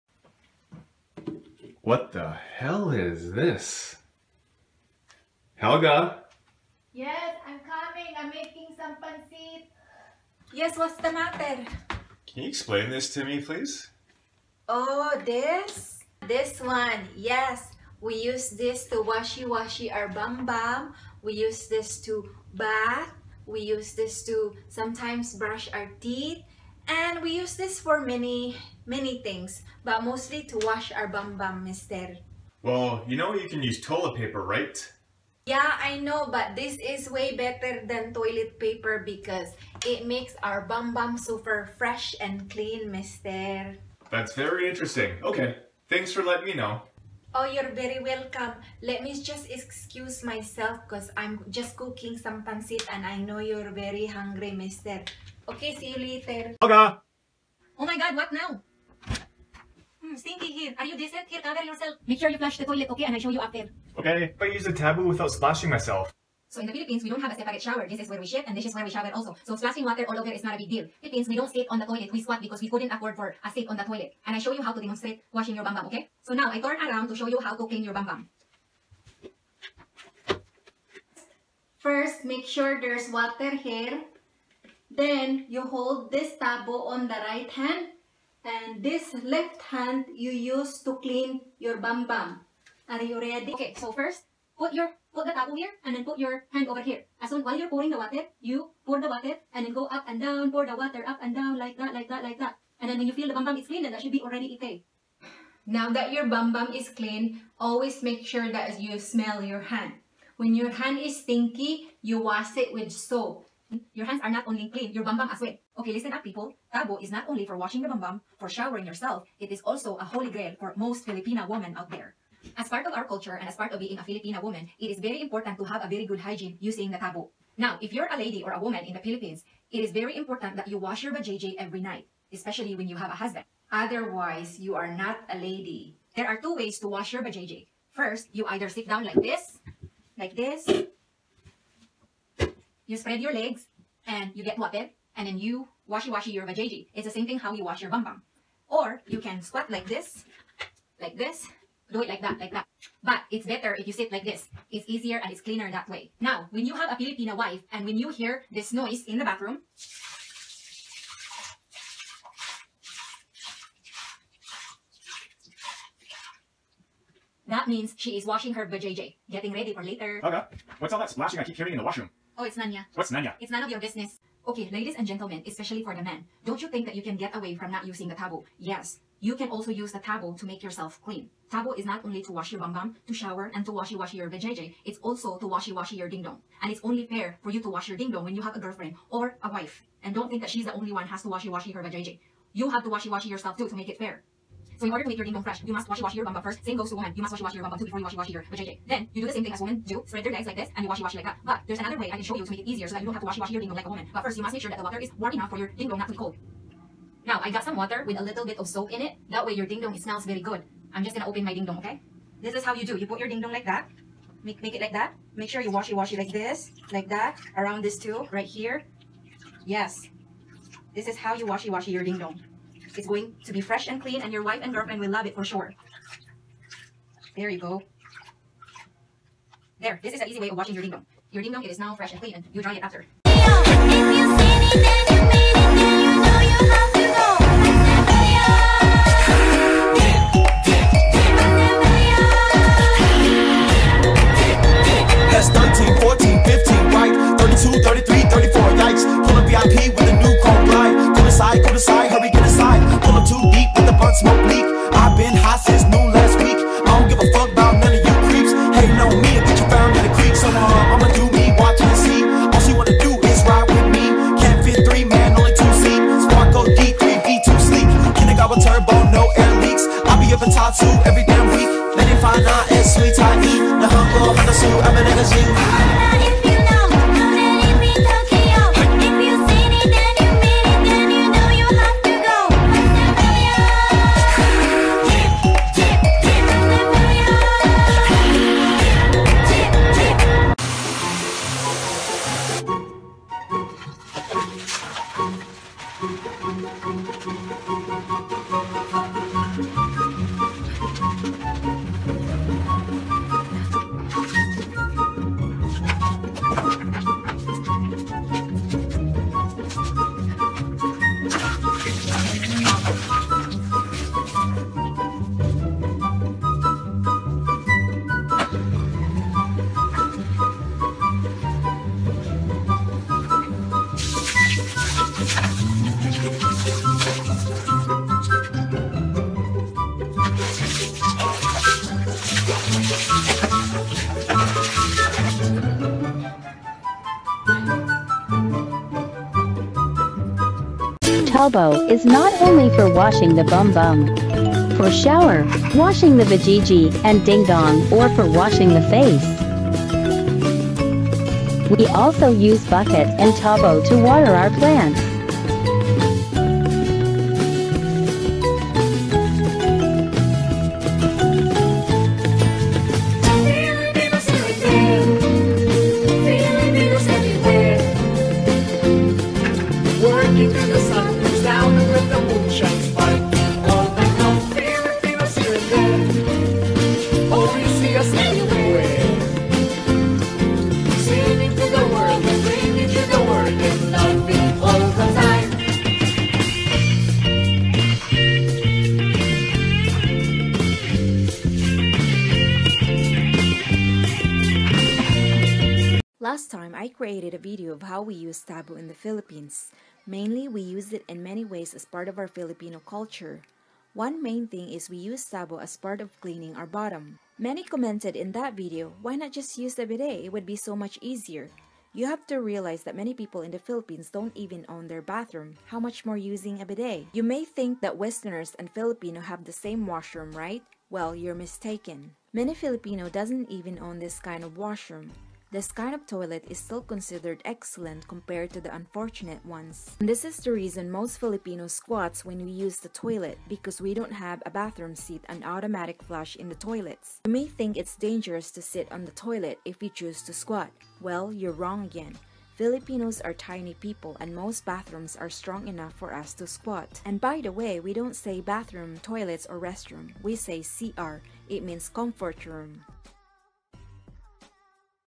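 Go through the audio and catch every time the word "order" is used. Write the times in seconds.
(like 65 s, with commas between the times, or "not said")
194 s.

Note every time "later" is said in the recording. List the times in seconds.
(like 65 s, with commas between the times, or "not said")
55 s, 169 s.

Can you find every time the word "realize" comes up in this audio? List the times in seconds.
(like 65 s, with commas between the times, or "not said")
412 s.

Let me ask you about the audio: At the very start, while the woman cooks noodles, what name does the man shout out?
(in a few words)
Helga.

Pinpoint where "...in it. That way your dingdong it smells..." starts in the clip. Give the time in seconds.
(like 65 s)
208 s.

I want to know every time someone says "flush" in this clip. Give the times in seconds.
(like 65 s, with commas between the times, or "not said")
62 s, 436 s.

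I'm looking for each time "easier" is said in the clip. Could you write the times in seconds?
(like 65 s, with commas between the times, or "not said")
154 s, 202 s, 411 s.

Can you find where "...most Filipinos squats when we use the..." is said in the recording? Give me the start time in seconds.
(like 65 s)
430 s.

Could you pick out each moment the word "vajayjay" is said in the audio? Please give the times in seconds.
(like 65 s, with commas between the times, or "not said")
146 s, 168 s, 184 s, 191 s, 198 s.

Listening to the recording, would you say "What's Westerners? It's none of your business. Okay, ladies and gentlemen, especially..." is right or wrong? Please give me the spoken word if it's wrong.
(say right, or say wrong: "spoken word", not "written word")
wrong: "Nanya", not "Westerners".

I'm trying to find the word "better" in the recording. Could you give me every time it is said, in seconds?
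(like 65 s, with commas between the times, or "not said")
37 s, 153 s.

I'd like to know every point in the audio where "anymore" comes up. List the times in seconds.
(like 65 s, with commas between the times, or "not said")
not said.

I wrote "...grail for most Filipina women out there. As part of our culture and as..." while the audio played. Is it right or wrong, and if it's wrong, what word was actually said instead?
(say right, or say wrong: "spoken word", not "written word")
right.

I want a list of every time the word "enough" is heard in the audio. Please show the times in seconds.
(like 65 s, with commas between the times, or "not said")
205 s, 445 s.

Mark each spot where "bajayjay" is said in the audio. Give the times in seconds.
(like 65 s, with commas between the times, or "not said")
131 s, 137 s.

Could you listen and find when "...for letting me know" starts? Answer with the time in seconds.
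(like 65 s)
46 s.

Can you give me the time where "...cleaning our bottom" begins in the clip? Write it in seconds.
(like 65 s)
406 s.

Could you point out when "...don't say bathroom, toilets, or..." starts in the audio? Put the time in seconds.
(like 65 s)
447 s.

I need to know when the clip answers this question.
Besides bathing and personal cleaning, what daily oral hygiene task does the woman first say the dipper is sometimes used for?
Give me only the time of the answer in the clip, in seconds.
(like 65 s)
25 s.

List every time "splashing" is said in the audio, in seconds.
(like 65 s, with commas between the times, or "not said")
65 s, 69 s, 171 s.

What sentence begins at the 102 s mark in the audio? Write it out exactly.
And then when you feel the bum bum is clean, then that should be already ite.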